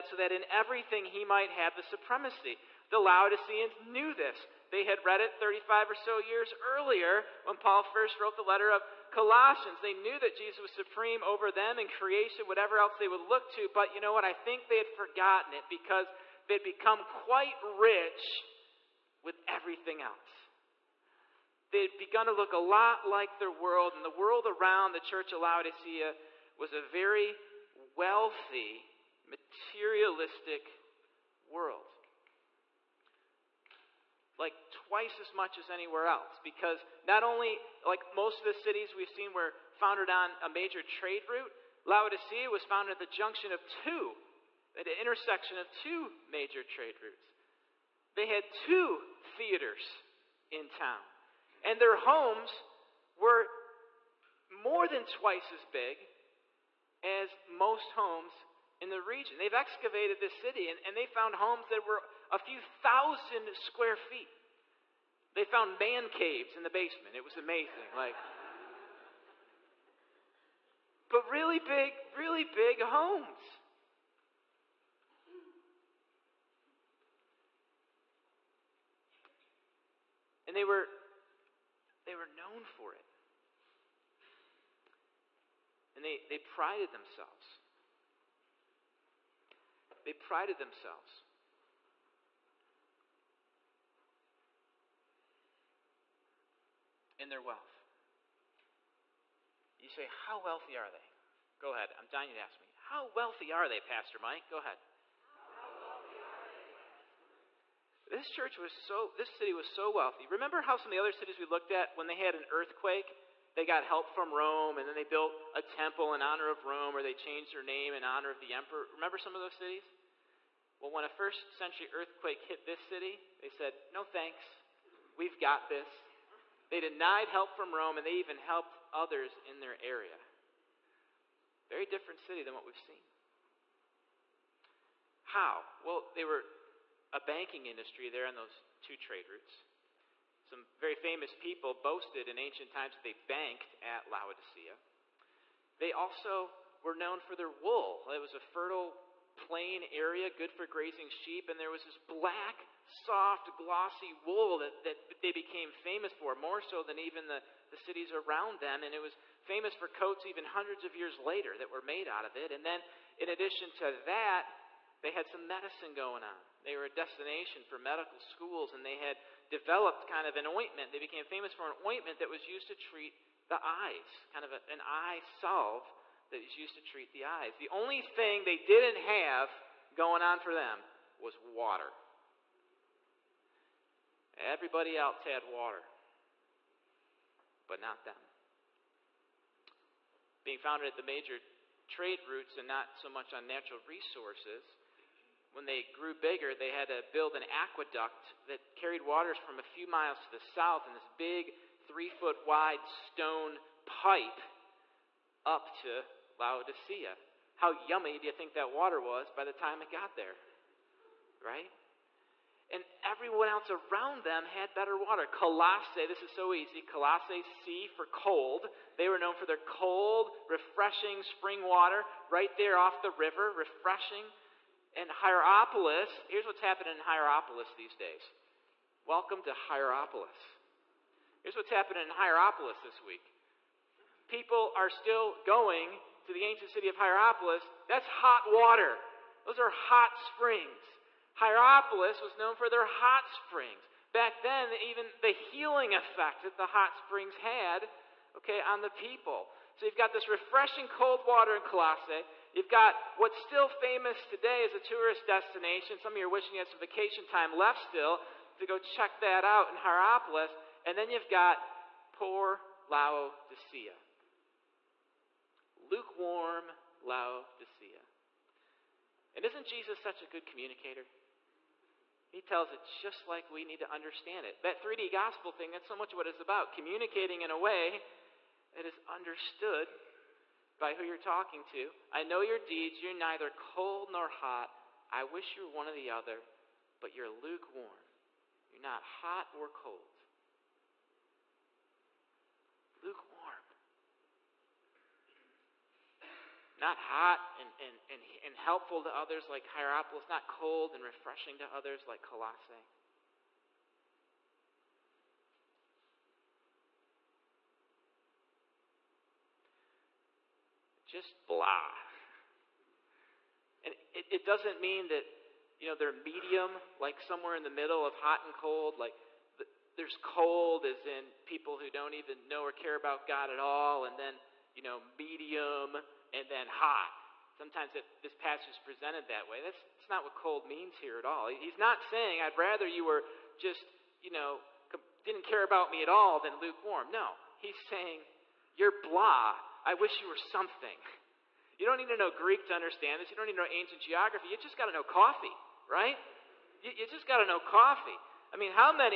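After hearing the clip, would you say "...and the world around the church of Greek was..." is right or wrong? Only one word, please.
wrong.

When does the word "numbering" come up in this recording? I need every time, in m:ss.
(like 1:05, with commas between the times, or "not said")
not said.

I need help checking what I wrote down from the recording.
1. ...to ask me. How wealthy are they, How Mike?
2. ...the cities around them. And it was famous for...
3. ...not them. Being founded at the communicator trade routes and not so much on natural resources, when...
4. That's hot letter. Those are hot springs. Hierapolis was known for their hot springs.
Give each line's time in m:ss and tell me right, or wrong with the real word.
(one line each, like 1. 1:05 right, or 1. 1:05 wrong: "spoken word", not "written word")
1. 1:42 wrong: "Pastor", not "How"
2. 2:37 right
3. 3:07 wrong: "major", not "communicator"
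4. 3:57 wrong: "water", not "letter".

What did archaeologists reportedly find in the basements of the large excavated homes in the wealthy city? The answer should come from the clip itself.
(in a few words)
Man caves.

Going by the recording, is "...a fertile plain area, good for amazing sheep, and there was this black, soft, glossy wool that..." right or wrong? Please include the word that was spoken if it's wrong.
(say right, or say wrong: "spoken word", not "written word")
wrong: "grazing", not "amazing".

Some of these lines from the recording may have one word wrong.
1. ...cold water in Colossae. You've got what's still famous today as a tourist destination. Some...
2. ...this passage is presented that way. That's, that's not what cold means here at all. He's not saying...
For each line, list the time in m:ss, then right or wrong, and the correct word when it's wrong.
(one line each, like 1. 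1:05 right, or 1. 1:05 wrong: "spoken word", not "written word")
1. 4:10 right
2. 5:28 right.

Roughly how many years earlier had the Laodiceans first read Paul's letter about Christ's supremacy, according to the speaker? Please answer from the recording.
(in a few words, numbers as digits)
35.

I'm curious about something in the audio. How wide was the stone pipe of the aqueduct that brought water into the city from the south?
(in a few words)
Three foot.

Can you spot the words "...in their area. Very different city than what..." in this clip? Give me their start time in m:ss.
2:09.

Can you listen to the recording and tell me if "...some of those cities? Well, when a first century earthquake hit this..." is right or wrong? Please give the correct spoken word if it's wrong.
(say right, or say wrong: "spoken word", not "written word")
right.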